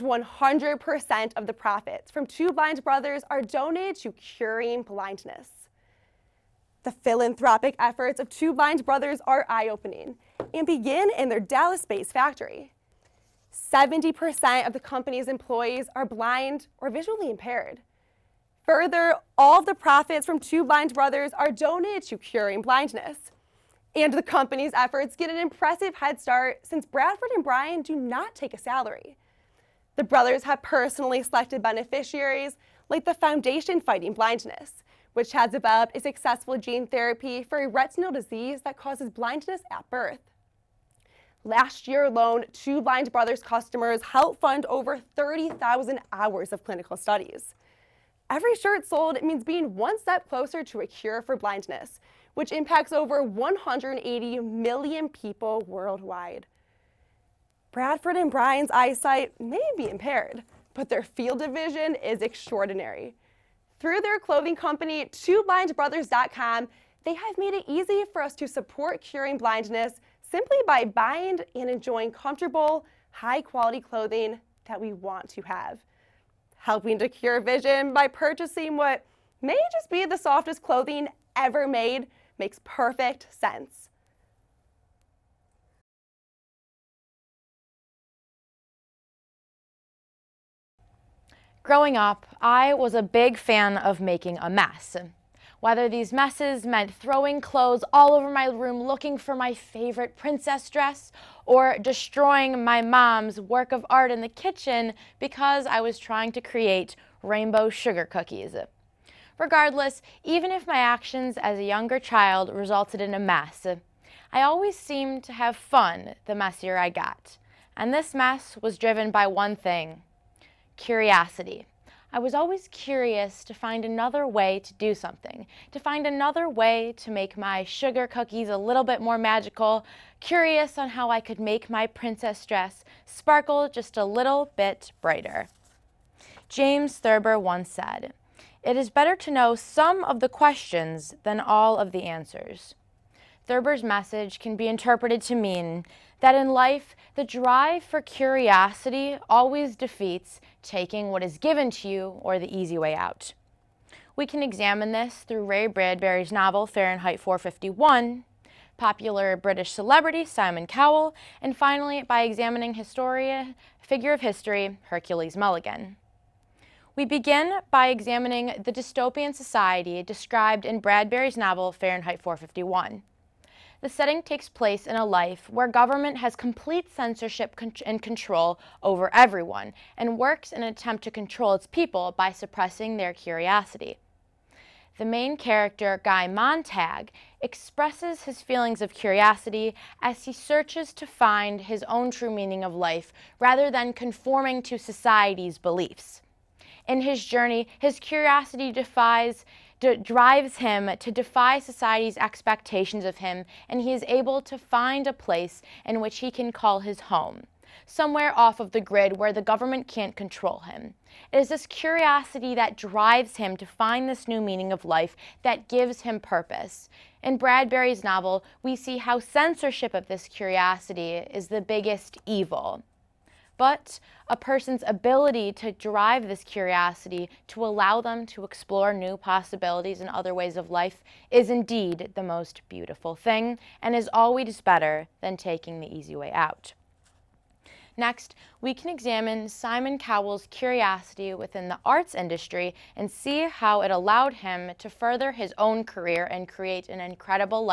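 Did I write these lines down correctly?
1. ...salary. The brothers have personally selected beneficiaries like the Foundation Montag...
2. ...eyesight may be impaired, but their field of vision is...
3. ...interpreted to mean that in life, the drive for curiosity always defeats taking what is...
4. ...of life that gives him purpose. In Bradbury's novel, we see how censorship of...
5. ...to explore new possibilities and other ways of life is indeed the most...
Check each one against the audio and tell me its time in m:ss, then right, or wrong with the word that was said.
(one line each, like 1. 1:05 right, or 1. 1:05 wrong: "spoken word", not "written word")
1. 0:28 wrong: "Fighting", not "Montag"
2. 0:58 right
3. 2:24 right
4. 3:34 right
5. 3:48 right.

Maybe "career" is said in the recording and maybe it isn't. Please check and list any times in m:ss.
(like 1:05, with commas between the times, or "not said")
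4:05.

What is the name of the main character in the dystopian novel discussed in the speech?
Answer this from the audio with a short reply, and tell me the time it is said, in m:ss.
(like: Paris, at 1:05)
Guy Montag, at 3:06.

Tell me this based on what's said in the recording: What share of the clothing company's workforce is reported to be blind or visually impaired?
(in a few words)
70%.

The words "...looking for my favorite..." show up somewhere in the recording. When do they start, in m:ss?
1:38.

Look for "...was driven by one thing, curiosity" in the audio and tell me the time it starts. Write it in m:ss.
1:58.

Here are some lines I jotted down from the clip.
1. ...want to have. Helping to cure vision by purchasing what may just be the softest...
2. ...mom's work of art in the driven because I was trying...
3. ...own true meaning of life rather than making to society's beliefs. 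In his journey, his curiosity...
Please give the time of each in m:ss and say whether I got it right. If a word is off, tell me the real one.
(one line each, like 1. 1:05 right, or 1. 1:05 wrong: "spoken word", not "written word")
1. 1:14 right
2. 1:42 wrong: "kitchen", not "driven"
3. 3:11 wrong: "conforming", not "making".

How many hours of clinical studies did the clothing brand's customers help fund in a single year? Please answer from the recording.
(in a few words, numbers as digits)
30,000.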